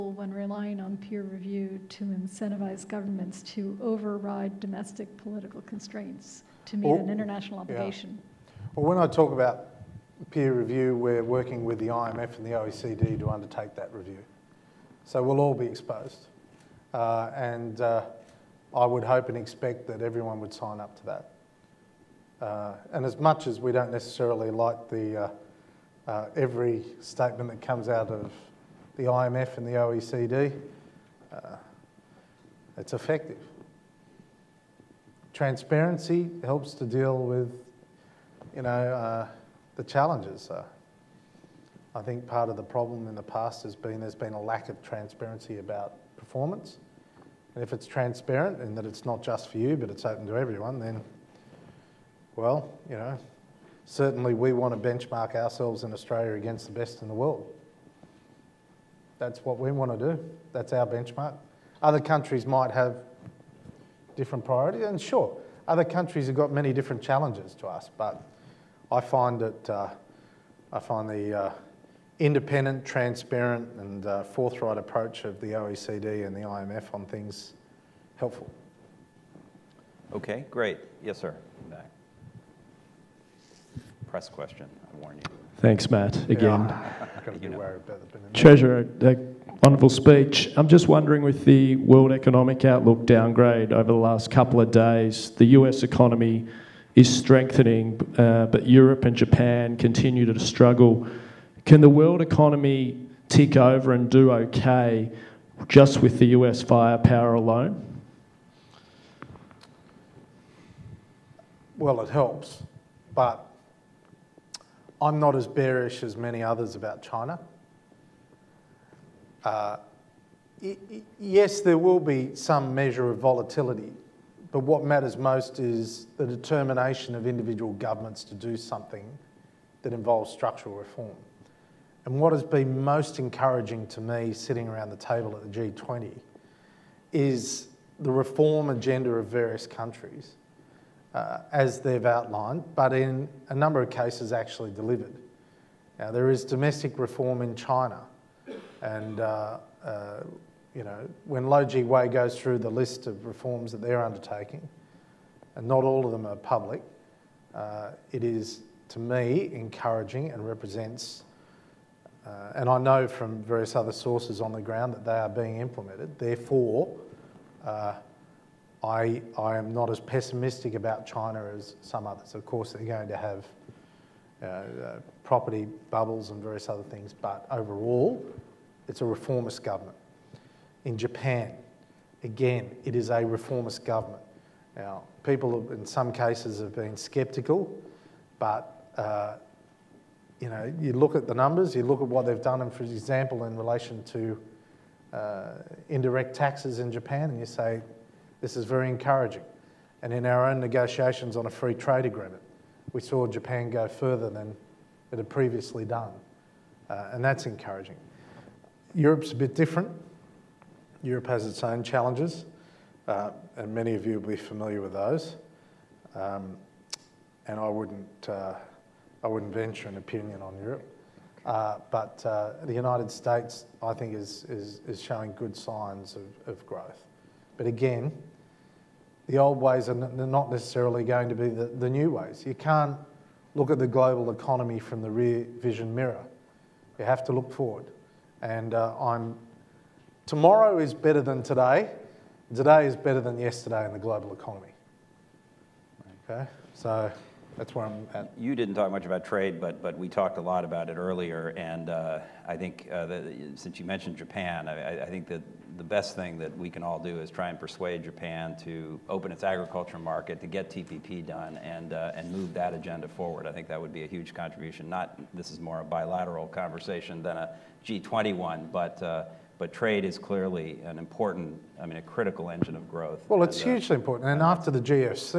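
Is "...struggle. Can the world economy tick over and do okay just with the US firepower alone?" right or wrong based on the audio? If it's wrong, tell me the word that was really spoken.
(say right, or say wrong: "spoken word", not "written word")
right.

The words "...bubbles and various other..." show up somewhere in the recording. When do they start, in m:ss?
2:55.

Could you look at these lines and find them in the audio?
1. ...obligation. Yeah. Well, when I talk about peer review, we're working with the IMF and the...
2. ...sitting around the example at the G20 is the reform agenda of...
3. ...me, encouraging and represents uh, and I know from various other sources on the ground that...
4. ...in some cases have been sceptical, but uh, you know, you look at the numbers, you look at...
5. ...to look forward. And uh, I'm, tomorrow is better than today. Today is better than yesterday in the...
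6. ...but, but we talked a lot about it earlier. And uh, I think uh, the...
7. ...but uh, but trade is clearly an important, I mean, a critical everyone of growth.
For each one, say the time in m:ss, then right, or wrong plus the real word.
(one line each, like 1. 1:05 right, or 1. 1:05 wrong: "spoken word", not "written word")
1. 0:07 right
2. 2:14 wrong: "table", not "example"
3. 2:38 right
4. 3:05 right
5. 3:57 right
6. 4:09 right
7. 4:28 wrong: "engine", not "everyone".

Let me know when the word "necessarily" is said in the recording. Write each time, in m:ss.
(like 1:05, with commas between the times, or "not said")
0:23, 3:50.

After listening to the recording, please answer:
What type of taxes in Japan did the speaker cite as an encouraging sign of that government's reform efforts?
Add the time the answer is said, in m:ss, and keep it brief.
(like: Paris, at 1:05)
Indirect taxes, at 3:15.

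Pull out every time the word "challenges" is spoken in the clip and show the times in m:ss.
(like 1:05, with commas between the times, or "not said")
0:39, 1:07, 3:31.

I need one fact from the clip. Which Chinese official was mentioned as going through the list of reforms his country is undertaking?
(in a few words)
Lou Jiwei.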